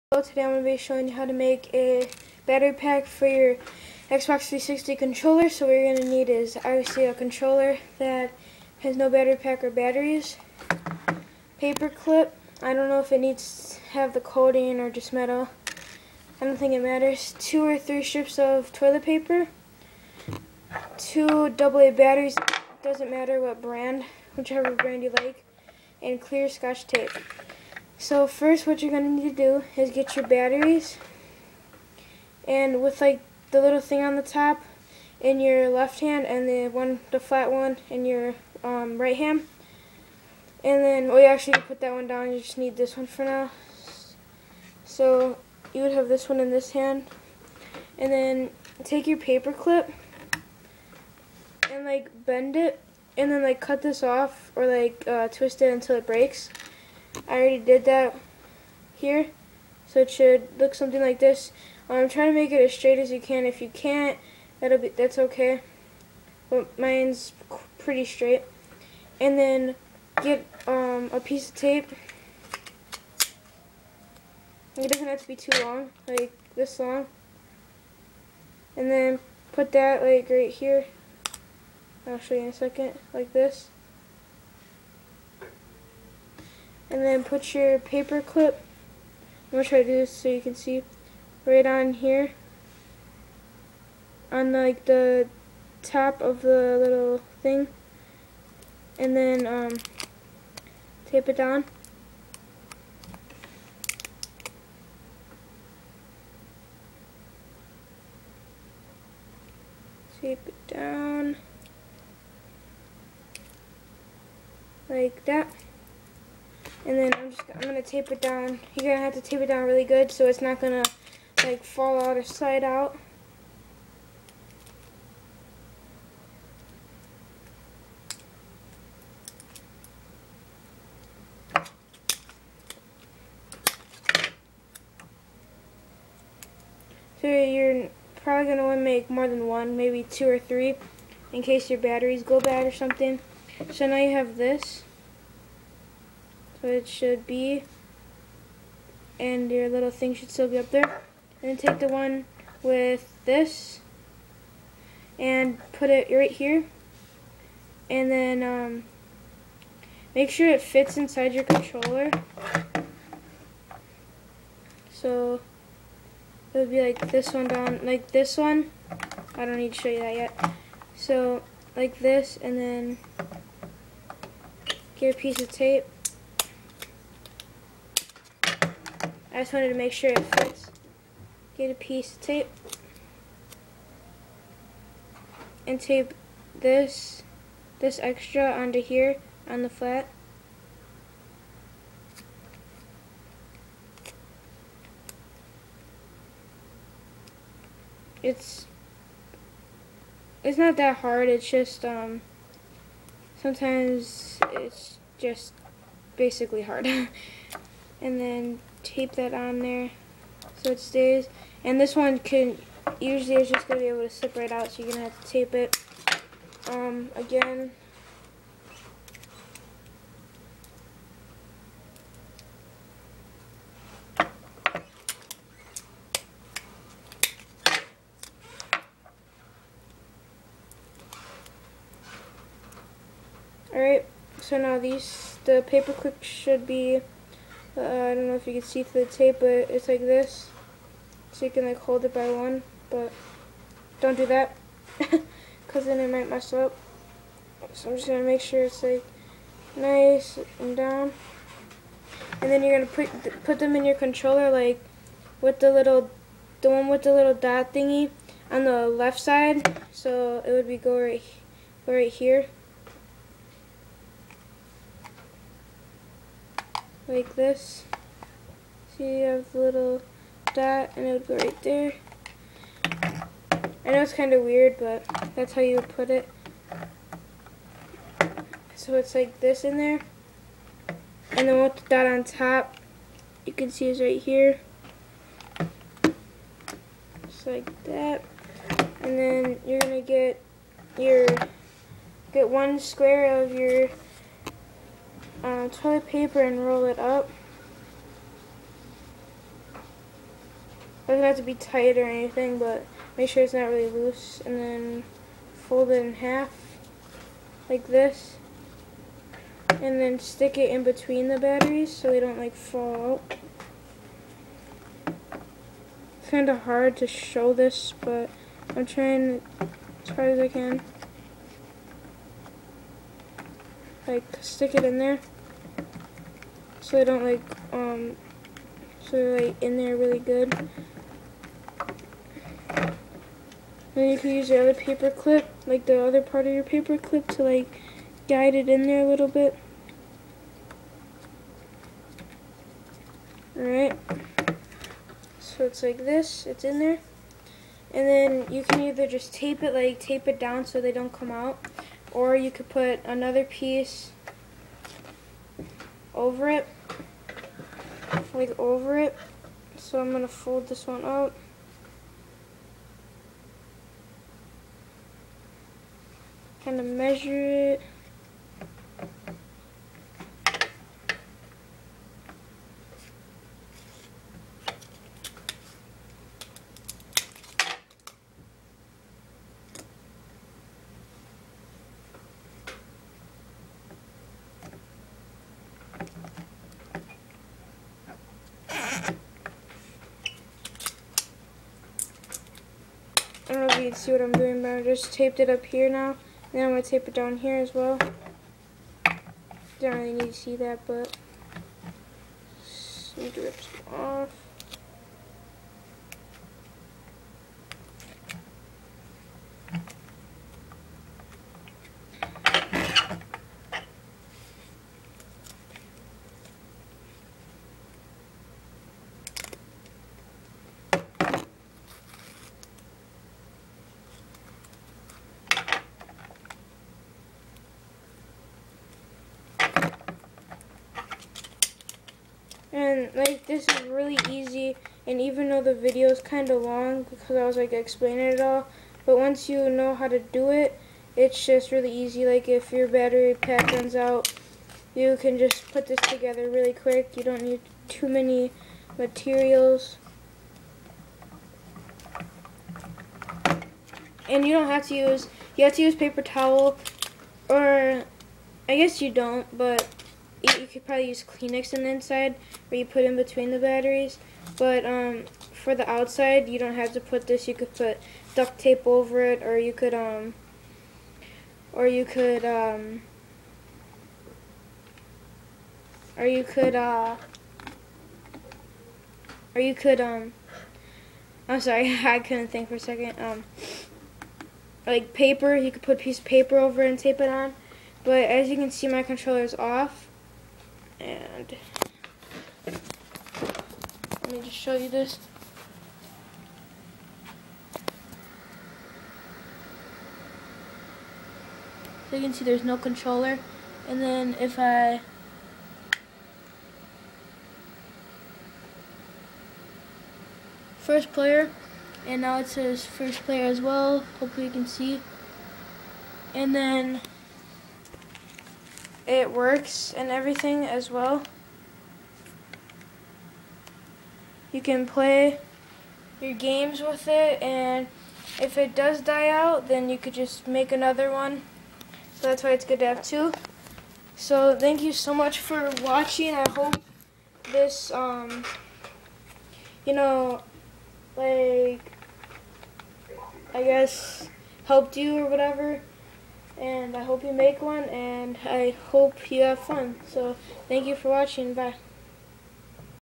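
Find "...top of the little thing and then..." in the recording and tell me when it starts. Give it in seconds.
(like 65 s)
95 s.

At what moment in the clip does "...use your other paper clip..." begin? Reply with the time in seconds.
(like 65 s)
334 s.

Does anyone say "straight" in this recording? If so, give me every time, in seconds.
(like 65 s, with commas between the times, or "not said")
62 s, 68 s.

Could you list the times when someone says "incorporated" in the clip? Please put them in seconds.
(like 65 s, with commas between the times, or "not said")
not said.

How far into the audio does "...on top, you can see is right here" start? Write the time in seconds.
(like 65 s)
282 s.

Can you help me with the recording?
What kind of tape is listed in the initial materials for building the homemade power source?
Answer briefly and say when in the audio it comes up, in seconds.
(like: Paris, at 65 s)
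Clear scotch tape, at 26 s.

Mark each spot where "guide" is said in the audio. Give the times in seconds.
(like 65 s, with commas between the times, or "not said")
338 s.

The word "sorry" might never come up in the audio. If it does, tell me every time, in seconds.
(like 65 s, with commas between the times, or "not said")
481 s.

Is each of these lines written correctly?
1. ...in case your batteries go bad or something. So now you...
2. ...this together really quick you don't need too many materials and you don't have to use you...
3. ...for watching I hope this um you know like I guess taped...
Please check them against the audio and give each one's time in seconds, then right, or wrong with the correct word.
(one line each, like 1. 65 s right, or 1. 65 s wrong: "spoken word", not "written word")
1. 141 s right
2. 445 s right
3. 535 s wrong: "helped", not "taped".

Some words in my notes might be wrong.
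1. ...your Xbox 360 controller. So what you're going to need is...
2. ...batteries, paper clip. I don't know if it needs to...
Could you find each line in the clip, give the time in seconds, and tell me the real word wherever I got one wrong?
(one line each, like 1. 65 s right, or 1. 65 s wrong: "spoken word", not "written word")
1. 3 s right
2. 9 s right.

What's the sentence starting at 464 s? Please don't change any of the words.
But um, for the outside, you don't have to put this.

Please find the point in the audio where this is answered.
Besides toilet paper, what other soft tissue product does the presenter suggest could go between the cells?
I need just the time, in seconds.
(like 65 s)
461 s.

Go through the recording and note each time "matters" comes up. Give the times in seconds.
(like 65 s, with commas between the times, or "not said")
16 s, 23 s.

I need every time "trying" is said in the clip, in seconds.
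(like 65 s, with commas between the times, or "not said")
62 s, 318 s.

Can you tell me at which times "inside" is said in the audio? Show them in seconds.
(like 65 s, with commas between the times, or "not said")
160 s, 461 s.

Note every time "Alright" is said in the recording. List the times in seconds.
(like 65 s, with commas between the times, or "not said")
233 s, 343 s.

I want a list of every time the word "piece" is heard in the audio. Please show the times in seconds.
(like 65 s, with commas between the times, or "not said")
71 s, 175 s, 181 s, 353 s, 486 s.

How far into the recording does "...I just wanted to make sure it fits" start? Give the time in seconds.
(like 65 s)
179 s.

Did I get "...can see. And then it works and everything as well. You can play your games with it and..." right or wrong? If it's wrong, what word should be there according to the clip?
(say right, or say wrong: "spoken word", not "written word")
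right.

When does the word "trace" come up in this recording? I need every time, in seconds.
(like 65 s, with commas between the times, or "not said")
not said.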